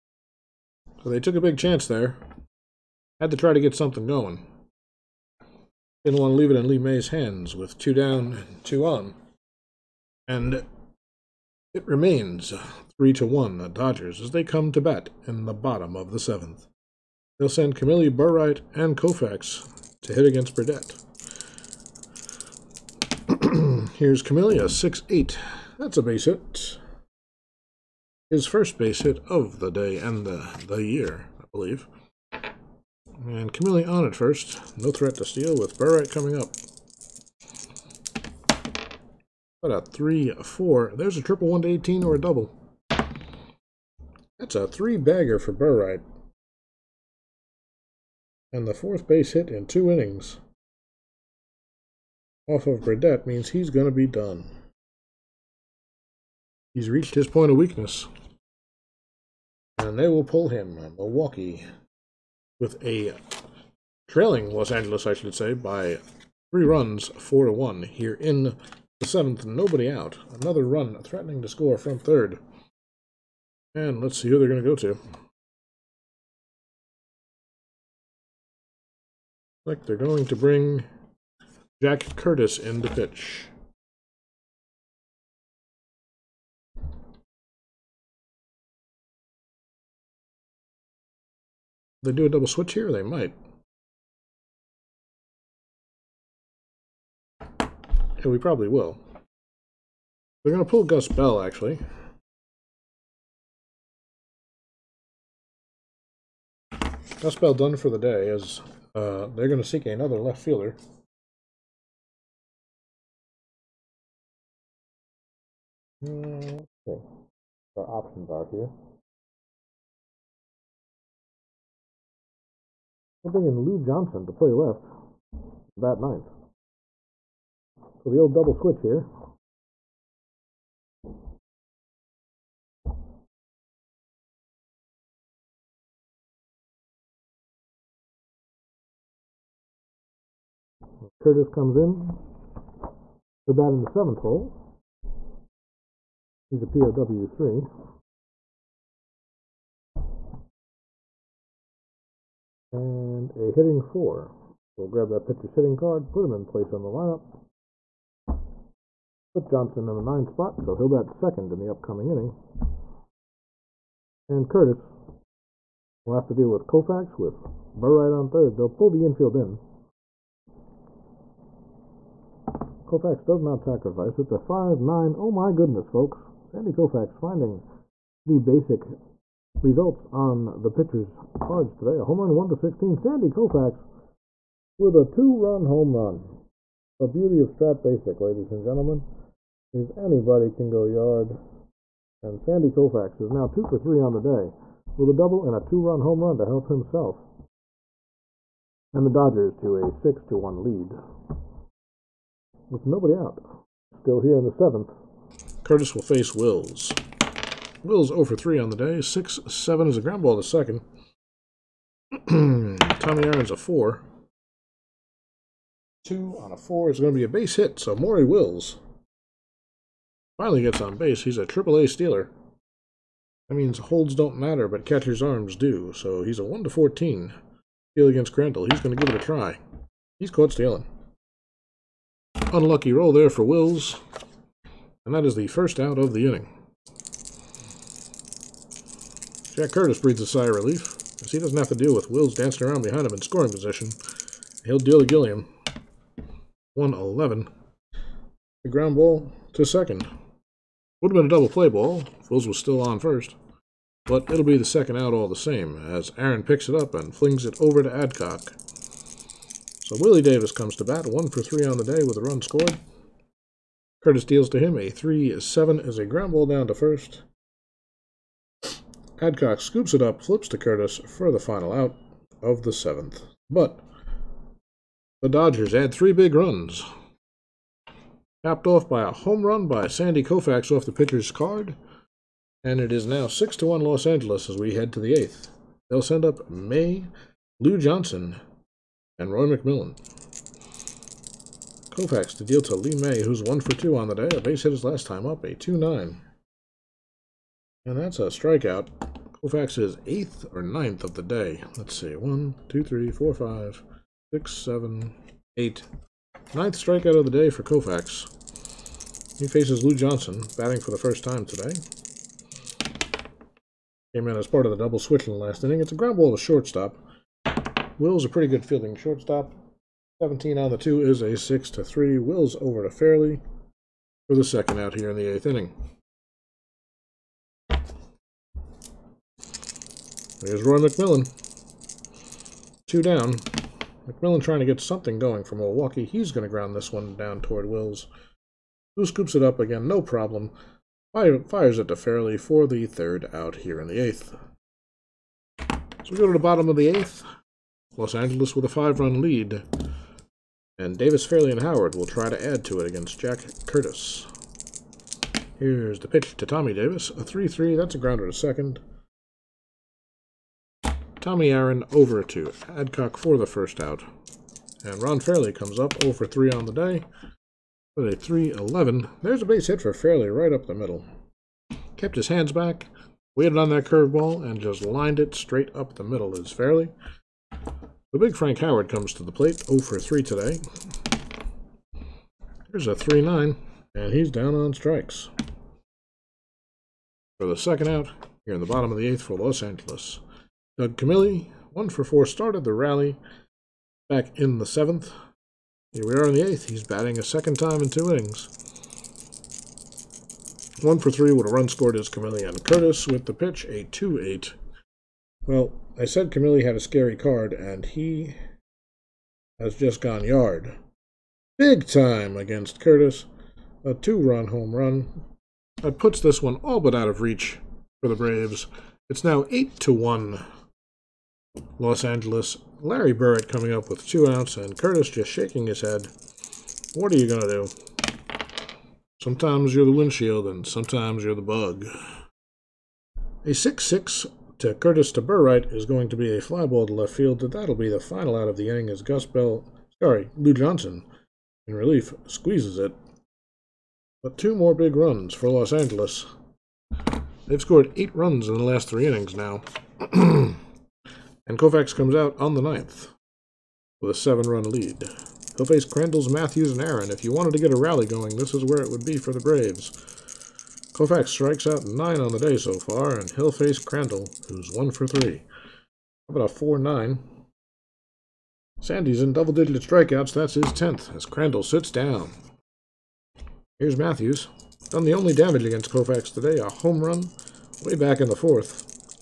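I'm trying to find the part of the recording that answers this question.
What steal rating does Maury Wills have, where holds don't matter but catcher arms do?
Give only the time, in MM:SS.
03:41.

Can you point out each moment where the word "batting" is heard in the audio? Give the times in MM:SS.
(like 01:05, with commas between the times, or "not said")
05:10, 06:36.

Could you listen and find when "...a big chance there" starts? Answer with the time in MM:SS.
00:01.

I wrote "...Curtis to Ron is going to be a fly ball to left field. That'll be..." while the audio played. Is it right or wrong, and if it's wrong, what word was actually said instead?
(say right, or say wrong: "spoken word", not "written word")
wrong: "Burright", not "Ron".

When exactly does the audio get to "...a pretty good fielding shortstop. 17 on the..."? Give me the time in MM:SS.
05:18.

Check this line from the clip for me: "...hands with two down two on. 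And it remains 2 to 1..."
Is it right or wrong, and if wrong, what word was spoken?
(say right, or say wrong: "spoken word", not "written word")
wrong: "3", not "2".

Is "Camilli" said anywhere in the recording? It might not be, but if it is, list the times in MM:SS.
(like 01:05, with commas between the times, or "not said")
00:17, 00:24, 00:33, 06:30, 06:46.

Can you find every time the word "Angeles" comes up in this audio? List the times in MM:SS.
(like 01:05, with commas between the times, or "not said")
01:04, 04:44, 05:48, 06:29, 07:02, 07:25.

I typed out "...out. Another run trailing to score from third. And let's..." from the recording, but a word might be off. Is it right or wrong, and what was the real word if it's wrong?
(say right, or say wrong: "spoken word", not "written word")
wrong: "threatening", not "trailing".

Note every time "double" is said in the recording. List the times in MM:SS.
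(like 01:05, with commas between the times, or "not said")
00:42, 01:32, 02:08, 03:15, 04:11, 05:14, 07:49.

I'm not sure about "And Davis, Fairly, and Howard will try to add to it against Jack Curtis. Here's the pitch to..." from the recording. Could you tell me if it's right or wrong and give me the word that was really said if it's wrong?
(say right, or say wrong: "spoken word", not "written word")
right.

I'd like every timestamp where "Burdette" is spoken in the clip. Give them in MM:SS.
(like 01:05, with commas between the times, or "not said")
00:20, 00:52.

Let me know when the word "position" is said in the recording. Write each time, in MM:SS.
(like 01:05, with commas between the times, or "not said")
04:03.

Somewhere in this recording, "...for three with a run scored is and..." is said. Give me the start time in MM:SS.
06:40.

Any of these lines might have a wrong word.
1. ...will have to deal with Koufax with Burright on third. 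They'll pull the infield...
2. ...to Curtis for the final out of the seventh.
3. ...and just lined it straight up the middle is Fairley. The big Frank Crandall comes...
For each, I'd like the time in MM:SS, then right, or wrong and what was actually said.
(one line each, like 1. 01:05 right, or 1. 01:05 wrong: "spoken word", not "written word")
1. 02:46 right
2. 04:30 right
3. 06:14 wrong: "Howard", not "Crandall".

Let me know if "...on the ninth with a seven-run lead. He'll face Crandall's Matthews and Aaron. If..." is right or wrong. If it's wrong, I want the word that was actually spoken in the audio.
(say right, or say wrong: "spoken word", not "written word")
right.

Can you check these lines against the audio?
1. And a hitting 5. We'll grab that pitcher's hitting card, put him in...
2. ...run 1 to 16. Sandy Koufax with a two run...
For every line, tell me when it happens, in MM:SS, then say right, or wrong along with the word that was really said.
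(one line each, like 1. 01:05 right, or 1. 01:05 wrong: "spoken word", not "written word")
1. 02:32 wrong: "4", not "5"
2. 03:02 right.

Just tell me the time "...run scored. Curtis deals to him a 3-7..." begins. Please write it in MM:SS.
04:22.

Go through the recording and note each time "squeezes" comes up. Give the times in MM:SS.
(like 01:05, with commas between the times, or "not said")
07:22.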